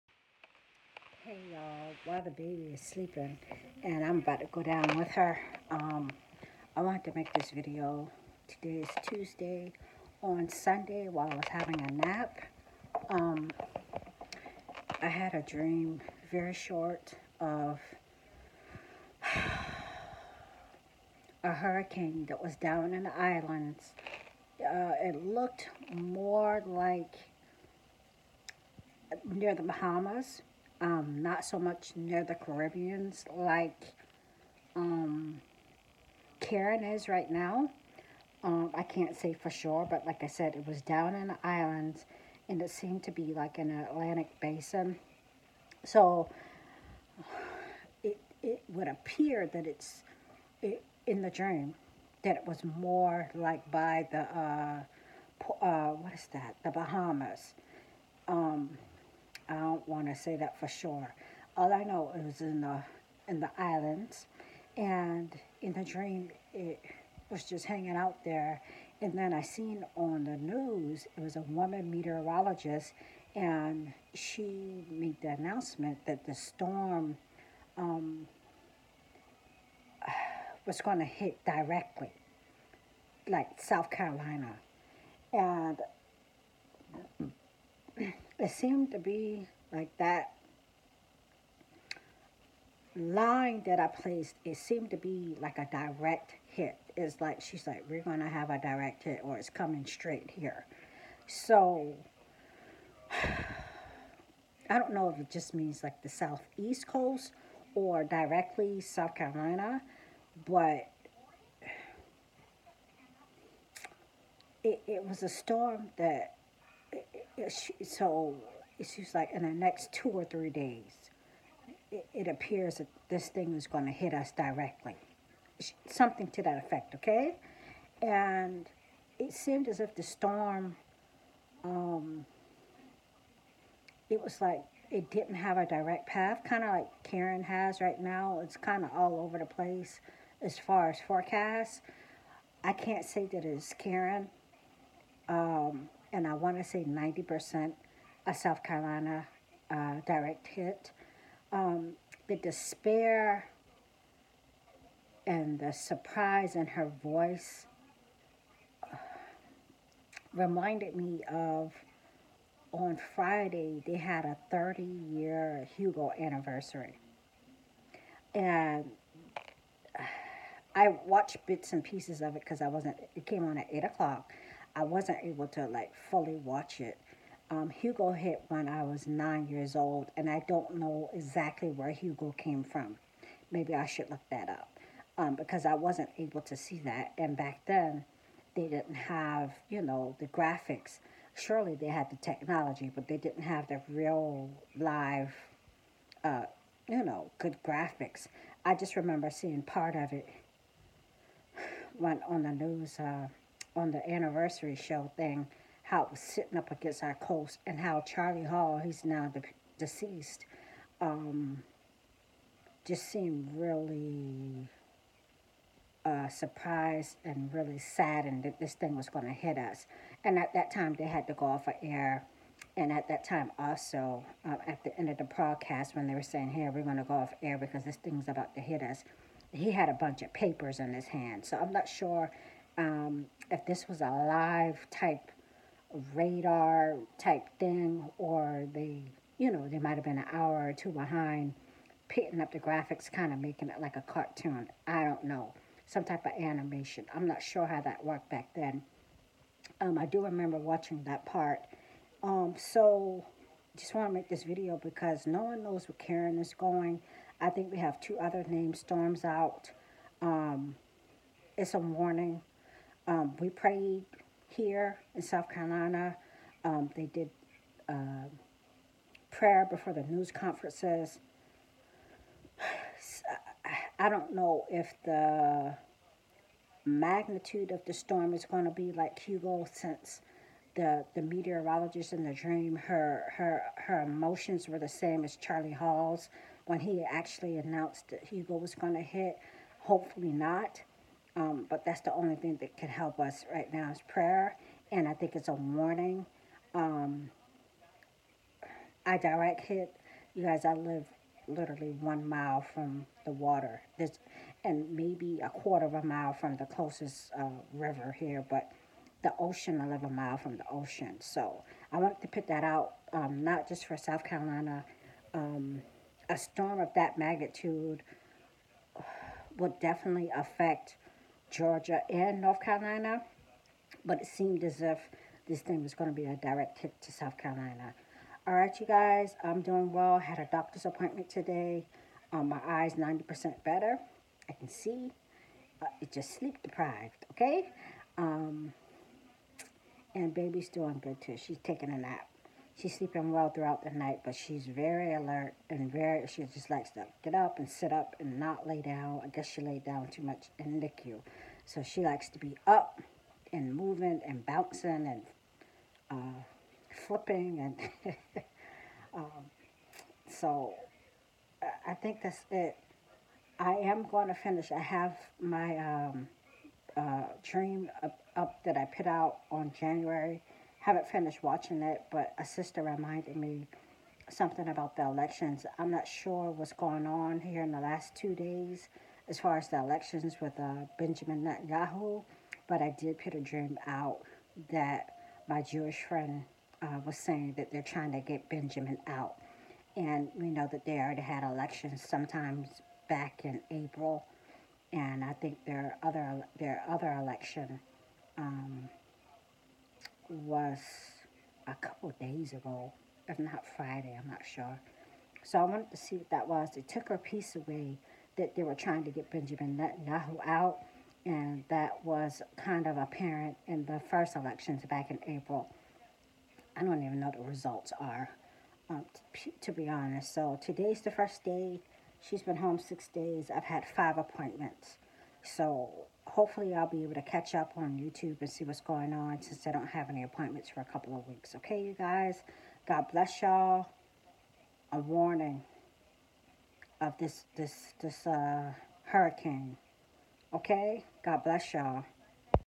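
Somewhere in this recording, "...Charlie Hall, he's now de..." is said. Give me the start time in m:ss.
3:28.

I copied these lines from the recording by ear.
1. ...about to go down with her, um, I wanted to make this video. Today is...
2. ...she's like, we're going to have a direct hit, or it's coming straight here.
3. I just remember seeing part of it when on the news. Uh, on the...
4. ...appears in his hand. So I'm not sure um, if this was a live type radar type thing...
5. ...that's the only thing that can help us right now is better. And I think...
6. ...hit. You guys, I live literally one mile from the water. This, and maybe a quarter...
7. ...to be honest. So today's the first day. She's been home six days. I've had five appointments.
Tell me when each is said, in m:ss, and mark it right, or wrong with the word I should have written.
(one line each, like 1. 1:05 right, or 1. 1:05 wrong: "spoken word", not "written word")
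1. 0:04 right
2. 1:37 right
3. 3:18 right
4. 3:50 wrong: "papers", not "appears"
5. 4:51 wrong: "prayer", not "better"
6. 4:59 right
7. 6:59 right.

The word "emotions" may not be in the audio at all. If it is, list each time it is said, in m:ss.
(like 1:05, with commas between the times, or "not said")
4:44.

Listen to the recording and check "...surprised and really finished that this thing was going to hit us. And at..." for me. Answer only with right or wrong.
wrong.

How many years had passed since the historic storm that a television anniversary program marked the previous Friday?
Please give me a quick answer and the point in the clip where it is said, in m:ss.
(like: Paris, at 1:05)
30, at 2:44.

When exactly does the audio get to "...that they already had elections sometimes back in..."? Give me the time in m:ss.
6:30.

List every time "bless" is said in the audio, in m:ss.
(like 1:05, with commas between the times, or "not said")
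7:13, 7:21.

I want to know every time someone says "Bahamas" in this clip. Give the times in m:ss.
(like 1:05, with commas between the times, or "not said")
0:29, 0:56.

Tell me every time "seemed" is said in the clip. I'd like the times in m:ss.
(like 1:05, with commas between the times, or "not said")
0:42, 1:28, 1:34, 2:09, 3:33, 5:24.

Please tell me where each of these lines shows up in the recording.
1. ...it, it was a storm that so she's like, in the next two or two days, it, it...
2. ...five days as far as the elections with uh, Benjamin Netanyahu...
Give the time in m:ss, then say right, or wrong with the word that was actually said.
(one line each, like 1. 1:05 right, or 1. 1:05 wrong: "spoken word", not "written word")
1. 1:54 wrong: "three", not "two"
2. 6:18 wrong: "two", not "five".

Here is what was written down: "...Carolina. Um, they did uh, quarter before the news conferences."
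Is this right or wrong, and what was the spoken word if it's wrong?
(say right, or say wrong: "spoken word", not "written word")
wrong: "prayer", not "quarter".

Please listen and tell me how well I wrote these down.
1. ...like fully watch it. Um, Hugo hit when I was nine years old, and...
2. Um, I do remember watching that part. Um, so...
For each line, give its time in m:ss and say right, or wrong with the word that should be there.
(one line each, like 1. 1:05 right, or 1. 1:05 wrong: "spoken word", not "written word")
1. 2:55 right
2. 4:09 right.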